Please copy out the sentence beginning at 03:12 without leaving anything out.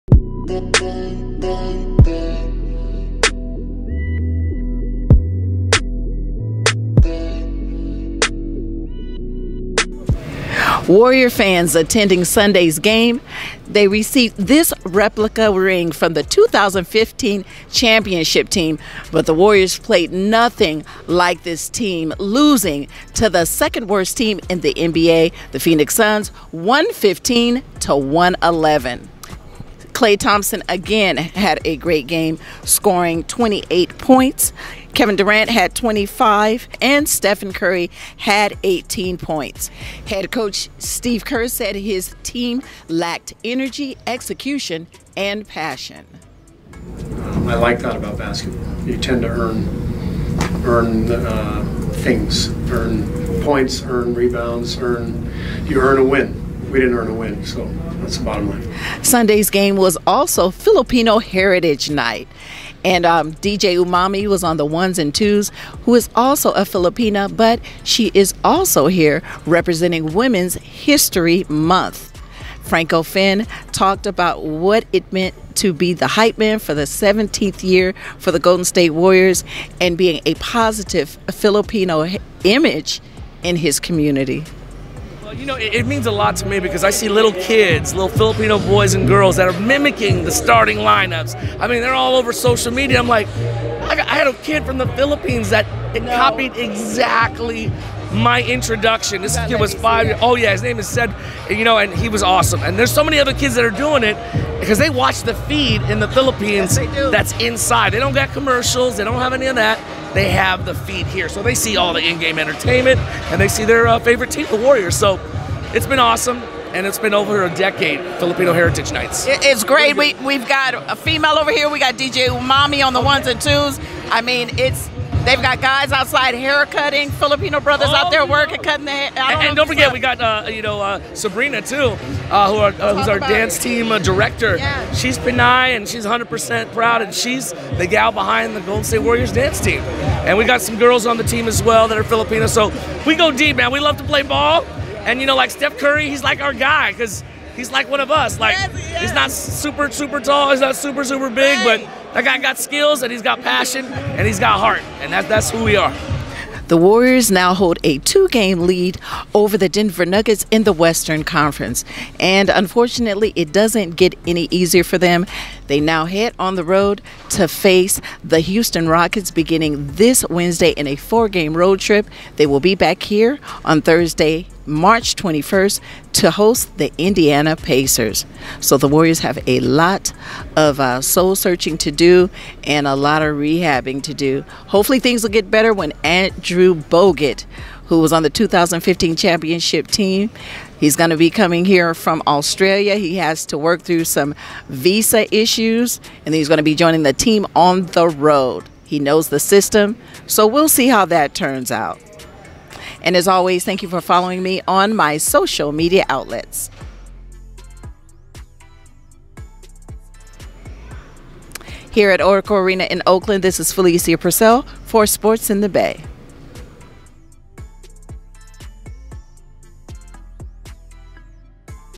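He has to work through some visa issues, and he's going to be joining the team on the road.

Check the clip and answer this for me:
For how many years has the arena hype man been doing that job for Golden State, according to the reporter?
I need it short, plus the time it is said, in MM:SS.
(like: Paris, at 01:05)
17th year, at 01:16.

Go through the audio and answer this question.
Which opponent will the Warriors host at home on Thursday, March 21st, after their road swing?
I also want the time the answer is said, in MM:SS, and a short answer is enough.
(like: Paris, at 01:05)
Indiana Pacers, at 02:56.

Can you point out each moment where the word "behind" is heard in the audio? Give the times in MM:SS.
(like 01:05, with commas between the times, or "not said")
02:18.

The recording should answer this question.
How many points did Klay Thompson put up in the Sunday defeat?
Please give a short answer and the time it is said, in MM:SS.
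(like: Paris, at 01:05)
28, at 00:33.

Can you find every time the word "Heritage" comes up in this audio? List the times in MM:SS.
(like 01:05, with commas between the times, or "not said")
01:01, 01:58.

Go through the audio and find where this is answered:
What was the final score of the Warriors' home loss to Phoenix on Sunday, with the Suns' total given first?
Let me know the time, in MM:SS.
00:26.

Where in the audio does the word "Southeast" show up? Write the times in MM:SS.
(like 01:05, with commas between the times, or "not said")
not said.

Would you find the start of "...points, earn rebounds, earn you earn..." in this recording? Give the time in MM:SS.
00:53.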